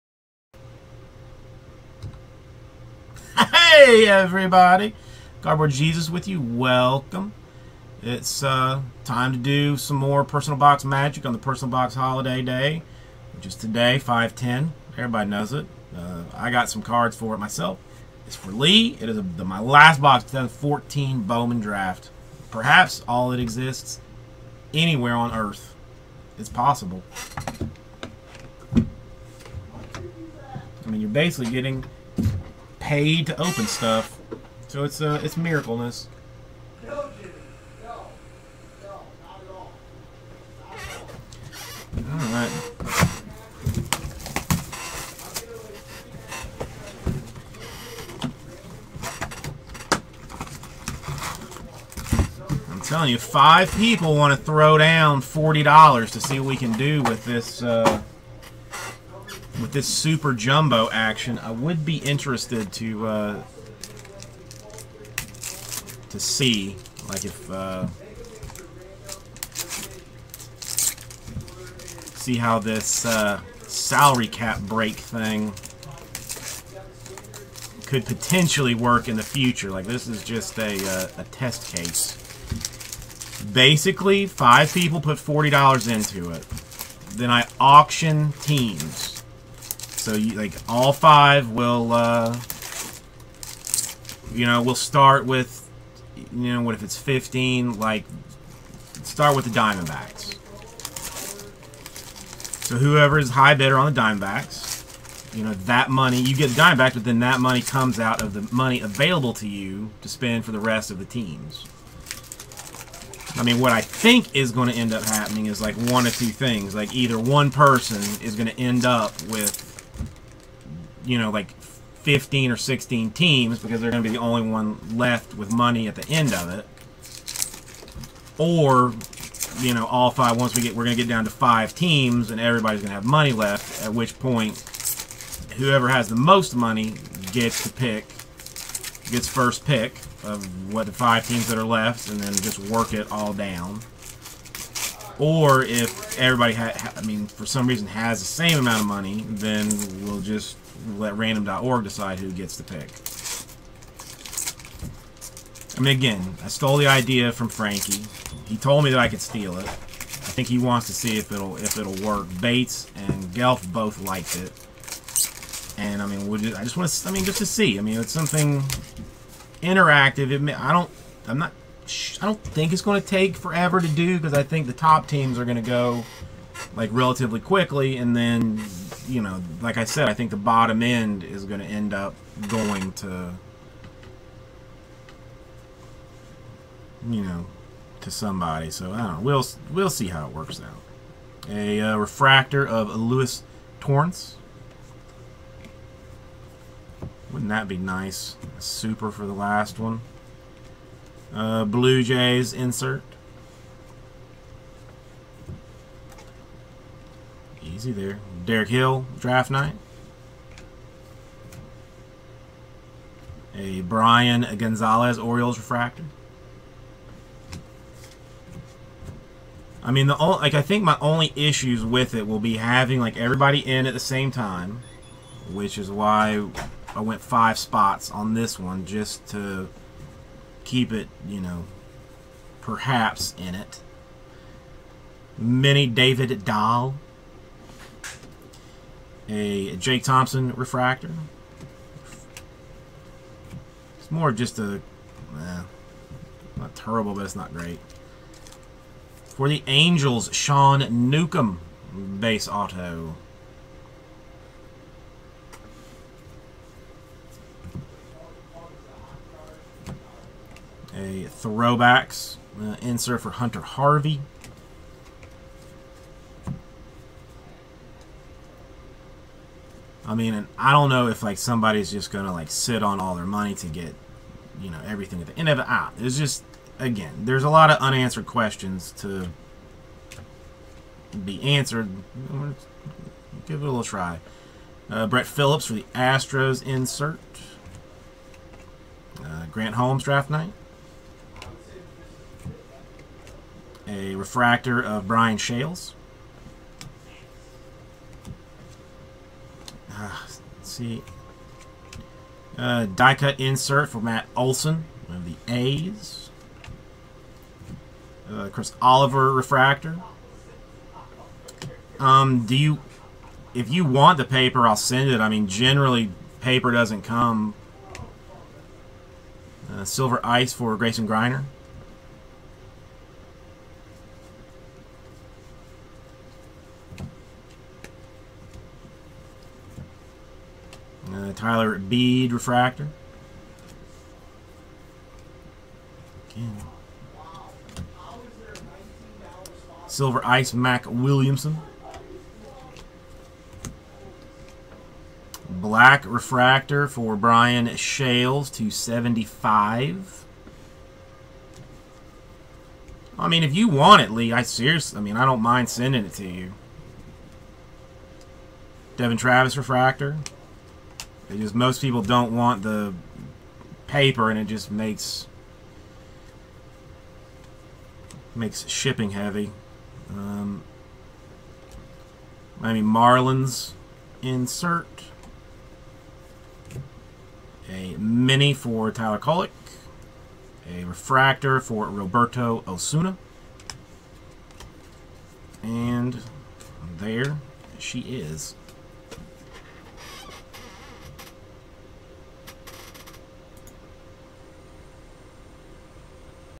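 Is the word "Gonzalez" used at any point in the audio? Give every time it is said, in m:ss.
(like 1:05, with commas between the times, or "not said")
3:34.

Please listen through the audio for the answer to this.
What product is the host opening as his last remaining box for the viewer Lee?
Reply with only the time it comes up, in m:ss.
0:20.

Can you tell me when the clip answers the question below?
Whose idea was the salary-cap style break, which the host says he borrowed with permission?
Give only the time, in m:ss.
2:37.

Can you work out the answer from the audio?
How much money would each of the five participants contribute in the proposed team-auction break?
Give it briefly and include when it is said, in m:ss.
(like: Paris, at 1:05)
$40, at 0:55.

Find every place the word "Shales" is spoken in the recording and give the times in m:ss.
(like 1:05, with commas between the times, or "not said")
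4:55, 5:47.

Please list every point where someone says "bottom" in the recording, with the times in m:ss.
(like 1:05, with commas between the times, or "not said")
3:00.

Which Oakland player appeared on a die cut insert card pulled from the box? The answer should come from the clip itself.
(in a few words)
Matt Olson.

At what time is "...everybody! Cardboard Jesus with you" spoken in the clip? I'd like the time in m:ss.
0:04.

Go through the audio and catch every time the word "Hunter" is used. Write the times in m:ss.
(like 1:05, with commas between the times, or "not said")
4:23.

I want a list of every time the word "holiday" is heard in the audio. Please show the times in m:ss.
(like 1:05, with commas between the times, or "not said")
0:11.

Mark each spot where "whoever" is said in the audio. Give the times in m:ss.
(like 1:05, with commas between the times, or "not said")
1:42, 2:15.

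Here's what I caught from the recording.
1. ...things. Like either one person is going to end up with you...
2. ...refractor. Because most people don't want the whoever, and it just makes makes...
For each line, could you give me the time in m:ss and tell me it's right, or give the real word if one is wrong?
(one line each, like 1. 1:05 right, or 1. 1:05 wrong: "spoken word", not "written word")
1. 1:56 right
2. 5:59 wrong: "paper", not "whoever".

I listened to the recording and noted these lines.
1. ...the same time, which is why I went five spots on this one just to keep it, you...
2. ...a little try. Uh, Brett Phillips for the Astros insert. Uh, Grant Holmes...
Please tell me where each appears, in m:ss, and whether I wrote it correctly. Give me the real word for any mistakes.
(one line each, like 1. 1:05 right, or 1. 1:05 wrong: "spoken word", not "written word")
1. 3:43 right
2. 4:43 right.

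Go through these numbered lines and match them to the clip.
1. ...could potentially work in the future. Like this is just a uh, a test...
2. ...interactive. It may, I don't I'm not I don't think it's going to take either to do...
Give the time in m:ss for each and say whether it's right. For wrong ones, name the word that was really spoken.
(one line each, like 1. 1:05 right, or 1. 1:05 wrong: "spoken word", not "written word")
1. 1:17 right
2. 2:49 wrong: "forever", not "either".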